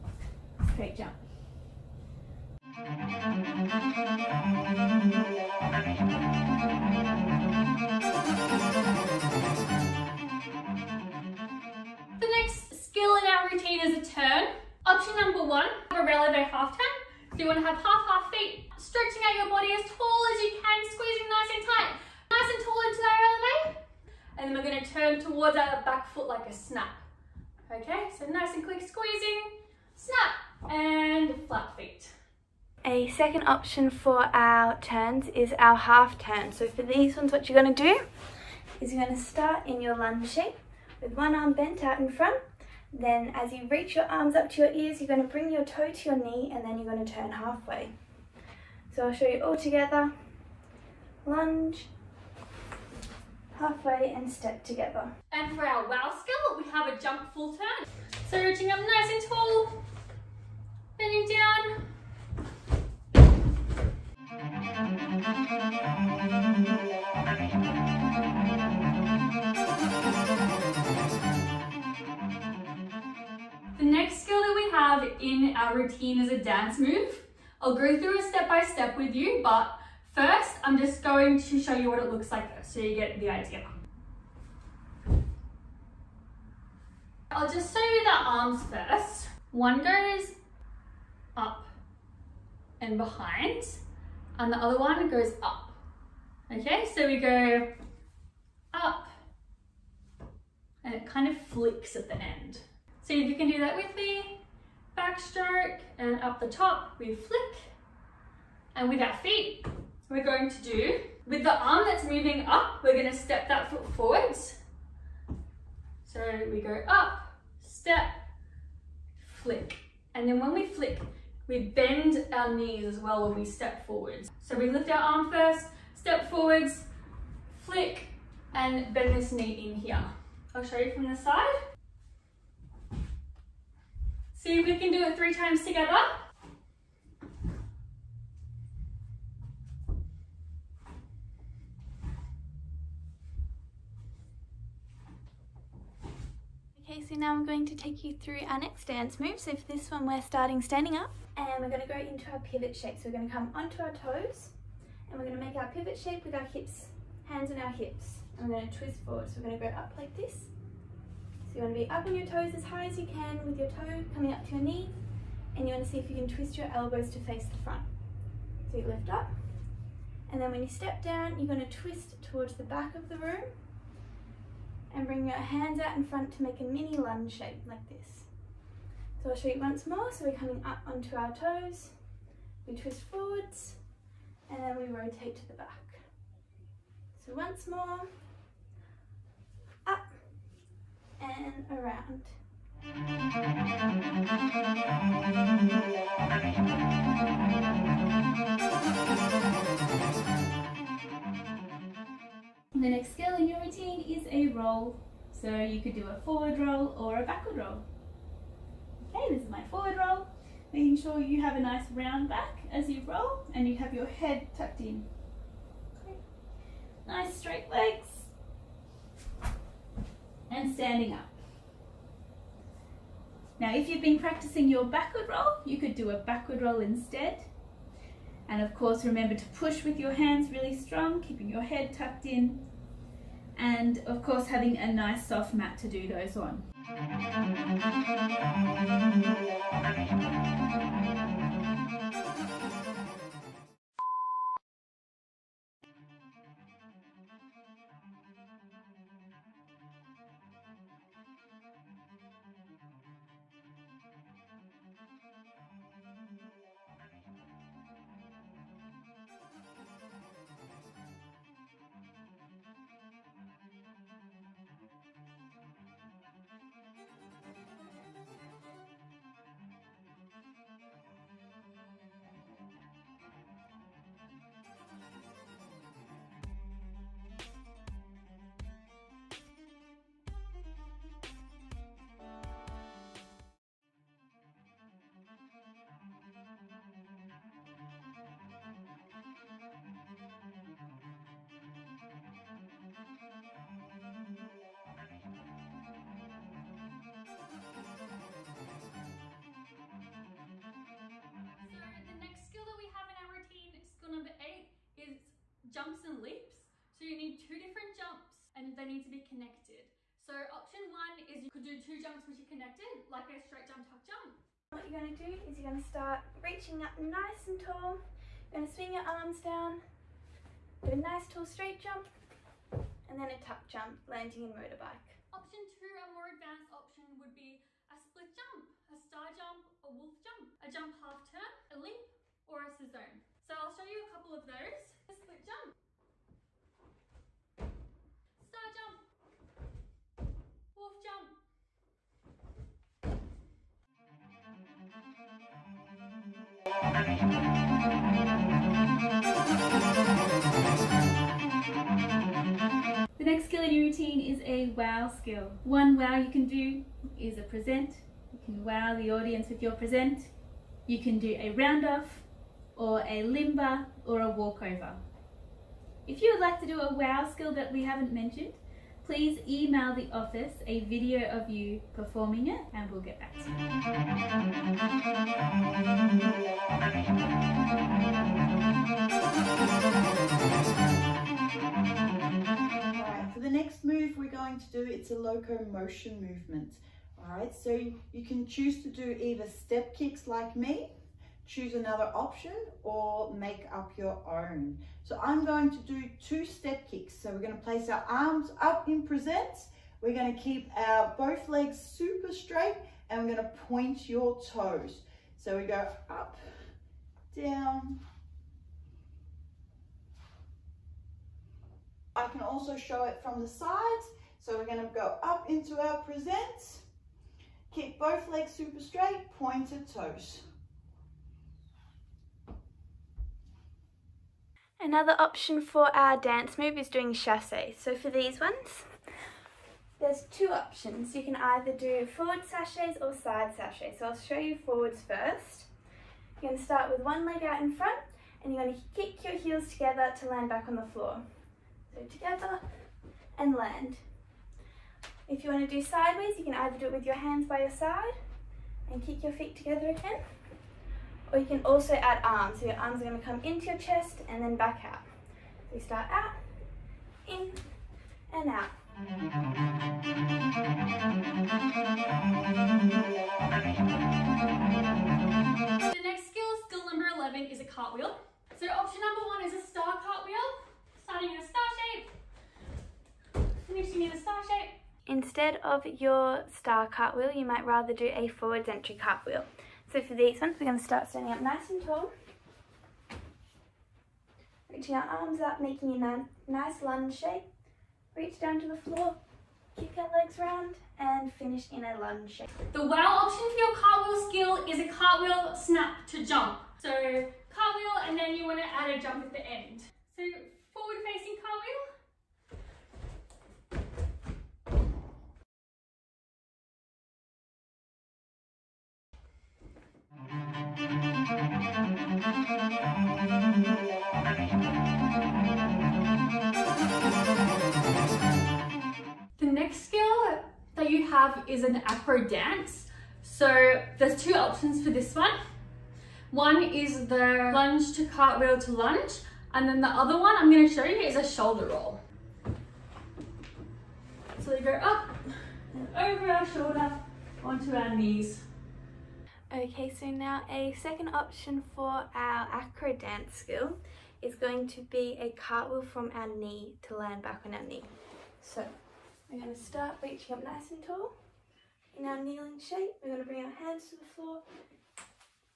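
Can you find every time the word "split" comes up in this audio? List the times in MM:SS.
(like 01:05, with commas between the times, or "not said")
05:27, 05:35.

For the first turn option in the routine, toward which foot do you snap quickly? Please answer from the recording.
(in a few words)
back foot.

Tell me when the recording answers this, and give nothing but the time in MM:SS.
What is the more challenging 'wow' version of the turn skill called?
00:56.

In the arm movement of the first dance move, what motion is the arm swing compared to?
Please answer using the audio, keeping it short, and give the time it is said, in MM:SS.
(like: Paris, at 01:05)
Backstroke, at 01:44.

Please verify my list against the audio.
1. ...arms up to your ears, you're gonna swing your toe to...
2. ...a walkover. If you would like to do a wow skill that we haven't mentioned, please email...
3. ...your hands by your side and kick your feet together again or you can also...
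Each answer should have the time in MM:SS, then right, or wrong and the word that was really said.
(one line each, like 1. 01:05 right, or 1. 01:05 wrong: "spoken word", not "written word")
1. 00:44 wrong: "bring", not "swing"
2. 06:04 right
3. 07:27 right.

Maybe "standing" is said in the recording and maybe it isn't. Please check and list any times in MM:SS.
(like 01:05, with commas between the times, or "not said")
02:30, 03:40, 08:01.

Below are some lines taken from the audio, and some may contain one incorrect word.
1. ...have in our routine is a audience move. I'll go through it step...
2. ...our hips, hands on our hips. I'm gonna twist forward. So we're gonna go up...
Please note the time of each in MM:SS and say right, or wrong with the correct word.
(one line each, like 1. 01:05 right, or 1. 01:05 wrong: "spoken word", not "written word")
1. 01:14 wrong: "dance", not "audience"
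2. 02:36 right.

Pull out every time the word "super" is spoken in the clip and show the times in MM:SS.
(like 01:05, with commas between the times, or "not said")
06:41, 06:58.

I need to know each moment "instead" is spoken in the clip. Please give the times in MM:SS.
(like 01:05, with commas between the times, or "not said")
03:46, 07:55.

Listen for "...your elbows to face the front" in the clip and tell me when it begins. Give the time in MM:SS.
02:46.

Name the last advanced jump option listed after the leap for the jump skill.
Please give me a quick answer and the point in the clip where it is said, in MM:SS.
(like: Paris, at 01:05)
sissone, at 05:32.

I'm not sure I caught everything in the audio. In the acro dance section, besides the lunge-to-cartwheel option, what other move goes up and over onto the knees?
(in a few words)
shoulder roll.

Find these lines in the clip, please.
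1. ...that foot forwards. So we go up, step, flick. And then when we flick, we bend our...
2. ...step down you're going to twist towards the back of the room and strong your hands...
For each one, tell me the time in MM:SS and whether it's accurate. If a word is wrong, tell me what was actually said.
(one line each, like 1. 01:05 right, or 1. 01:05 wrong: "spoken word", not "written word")
1. 01:53 right
2. 02:50 wrong: "bring", not "strong".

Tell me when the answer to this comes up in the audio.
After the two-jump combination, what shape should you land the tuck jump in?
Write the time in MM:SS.
05:24.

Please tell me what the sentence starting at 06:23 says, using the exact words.
Alright, for the next move we're going to do, it's a locomotion movement.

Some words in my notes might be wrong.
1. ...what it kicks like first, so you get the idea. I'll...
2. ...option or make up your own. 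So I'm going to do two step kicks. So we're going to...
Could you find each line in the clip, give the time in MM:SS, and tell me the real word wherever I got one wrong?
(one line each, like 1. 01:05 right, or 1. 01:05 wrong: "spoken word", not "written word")
1. 01:21 wrong: "looks", not "kicks"
2. 06:32 right.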